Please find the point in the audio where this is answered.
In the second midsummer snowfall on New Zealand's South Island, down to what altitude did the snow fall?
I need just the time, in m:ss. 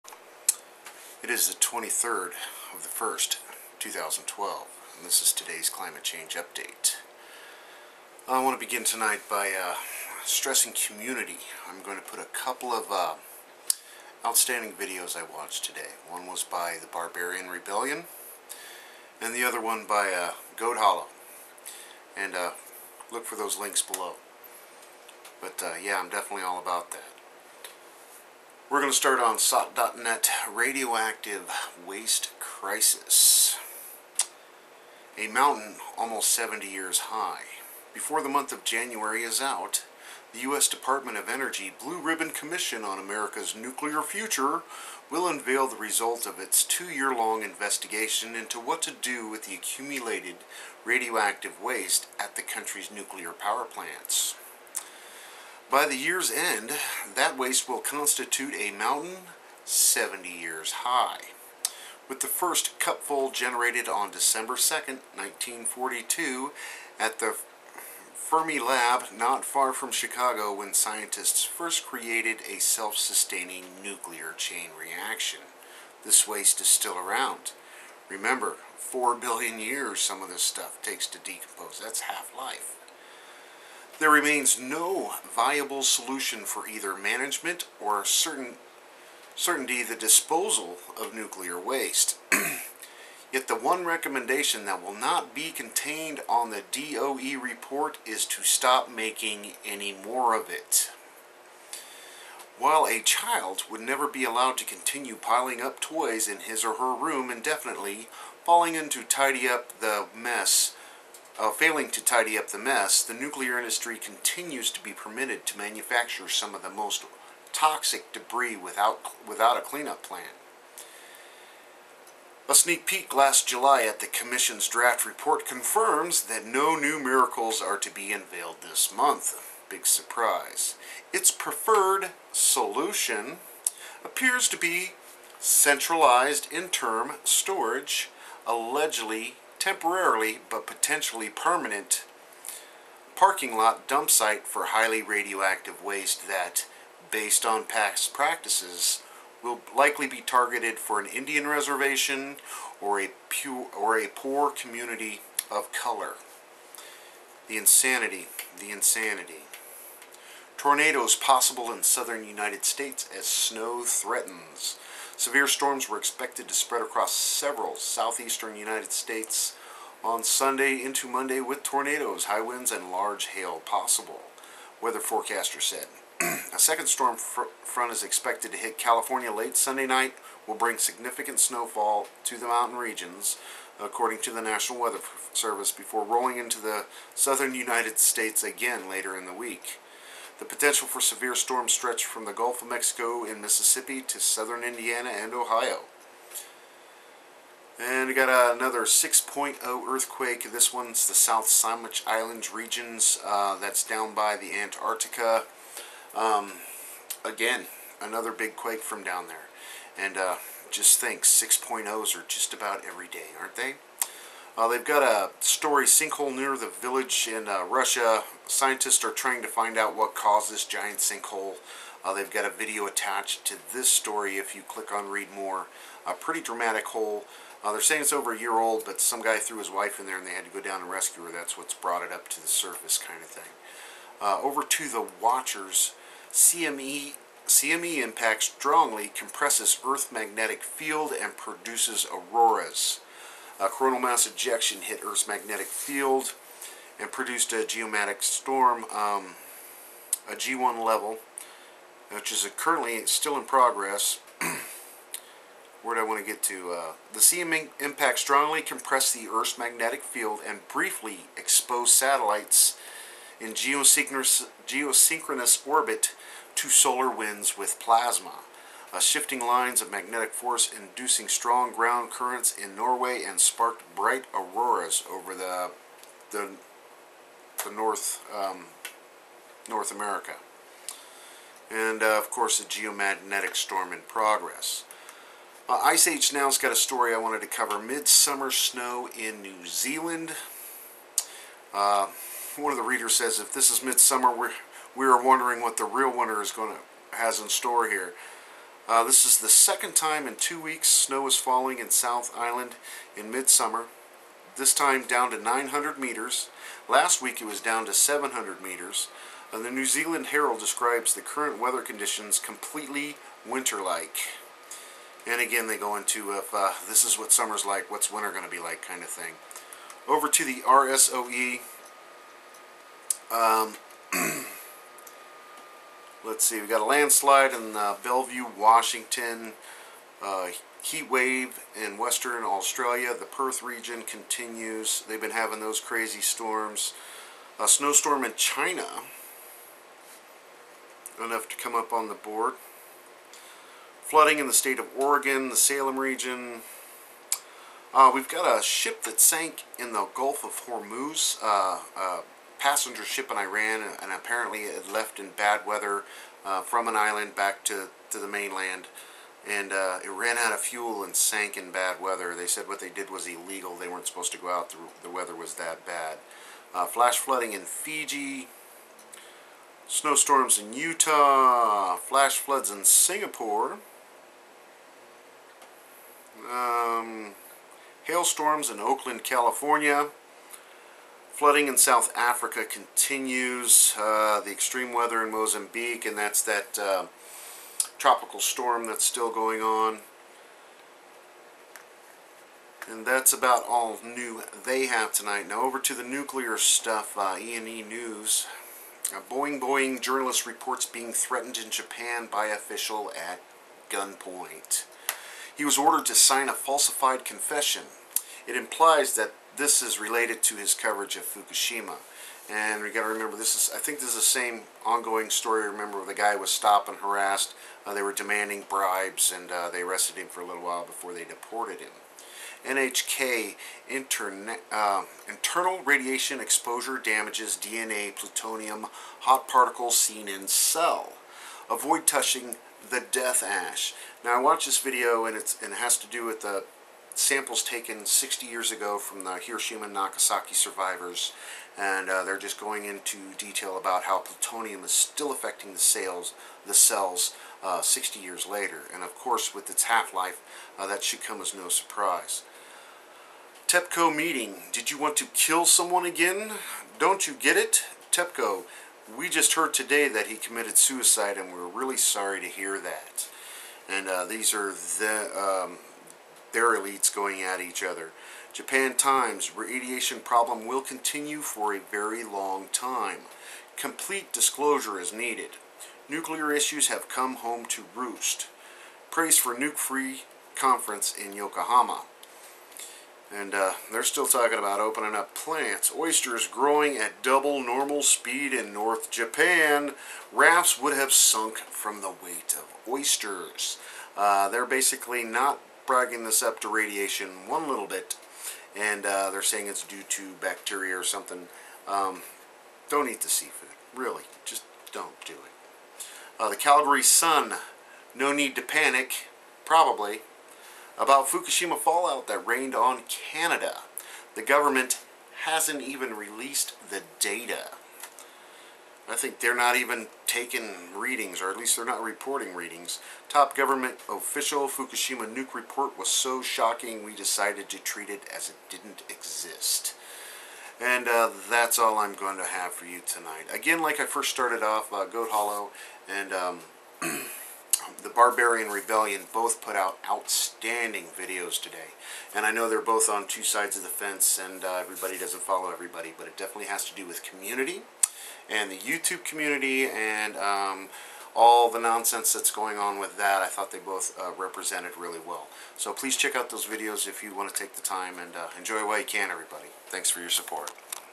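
5:05.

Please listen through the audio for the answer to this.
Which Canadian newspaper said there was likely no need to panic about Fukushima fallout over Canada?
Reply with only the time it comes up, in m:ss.
8:26.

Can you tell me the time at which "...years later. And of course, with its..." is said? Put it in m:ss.
7:28.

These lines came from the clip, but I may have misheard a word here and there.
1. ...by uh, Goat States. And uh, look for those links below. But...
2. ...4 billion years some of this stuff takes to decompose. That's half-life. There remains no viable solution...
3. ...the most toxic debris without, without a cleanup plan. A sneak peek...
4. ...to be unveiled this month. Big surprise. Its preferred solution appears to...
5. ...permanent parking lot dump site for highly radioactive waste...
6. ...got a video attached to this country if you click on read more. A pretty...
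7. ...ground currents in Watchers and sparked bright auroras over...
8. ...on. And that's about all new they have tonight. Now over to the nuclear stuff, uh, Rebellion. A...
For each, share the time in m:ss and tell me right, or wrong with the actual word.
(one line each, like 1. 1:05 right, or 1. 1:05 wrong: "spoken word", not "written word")
1. 0:19 wrong: "Hollow", not "States"
2. 1:18 right
3. 1:56 right
4. 2:07 right
5. 2:21 right
6. 3:42 wrong: "story", not "country"
7. 4:31 wrong: "Norway", not "Watchers"
8. 6:29 wrong: "ENENews", not "Rebellion".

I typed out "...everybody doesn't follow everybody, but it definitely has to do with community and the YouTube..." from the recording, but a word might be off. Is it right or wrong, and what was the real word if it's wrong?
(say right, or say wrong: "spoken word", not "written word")
right.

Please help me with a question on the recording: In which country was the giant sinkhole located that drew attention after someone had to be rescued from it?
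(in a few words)
Russia.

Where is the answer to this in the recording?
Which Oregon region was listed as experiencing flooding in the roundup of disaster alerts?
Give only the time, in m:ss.
5:45.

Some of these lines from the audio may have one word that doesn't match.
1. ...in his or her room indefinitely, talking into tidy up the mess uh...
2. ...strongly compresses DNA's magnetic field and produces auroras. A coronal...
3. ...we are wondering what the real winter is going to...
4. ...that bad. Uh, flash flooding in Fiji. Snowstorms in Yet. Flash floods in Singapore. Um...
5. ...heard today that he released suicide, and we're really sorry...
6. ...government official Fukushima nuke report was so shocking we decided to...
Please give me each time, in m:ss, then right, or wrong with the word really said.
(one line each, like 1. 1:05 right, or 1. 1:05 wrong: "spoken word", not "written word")
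1. 1:46 wrong: "falling", not "talking"
2. 3:58 wrong: "Earth", not "DNA"
3. 4:54 right
4. 6:05 wrong: "Utah", not "Yet"
5. 7:39 wrong: "committed", not "released"
6. 8:43 right.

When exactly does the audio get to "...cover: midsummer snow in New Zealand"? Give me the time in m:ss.
4:47.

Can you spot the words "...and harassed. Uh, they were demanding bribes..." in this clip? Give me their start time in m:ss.
6:56.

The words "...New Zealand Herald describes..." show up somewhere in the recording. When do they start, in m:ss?
5:09.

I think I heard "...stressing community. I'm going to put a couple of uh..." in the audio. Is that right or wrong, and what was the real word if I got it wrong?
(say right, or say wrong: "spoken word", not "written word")
right.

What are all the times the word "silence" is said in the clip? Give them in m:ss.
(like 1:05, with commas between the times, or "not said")
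not said.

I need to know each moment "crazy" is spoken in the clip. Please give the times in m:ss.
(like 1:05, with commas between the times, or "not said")
5:35.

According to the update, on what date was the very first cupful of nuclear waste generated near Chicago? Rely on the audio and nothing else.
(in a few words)
December 2nd, 1942.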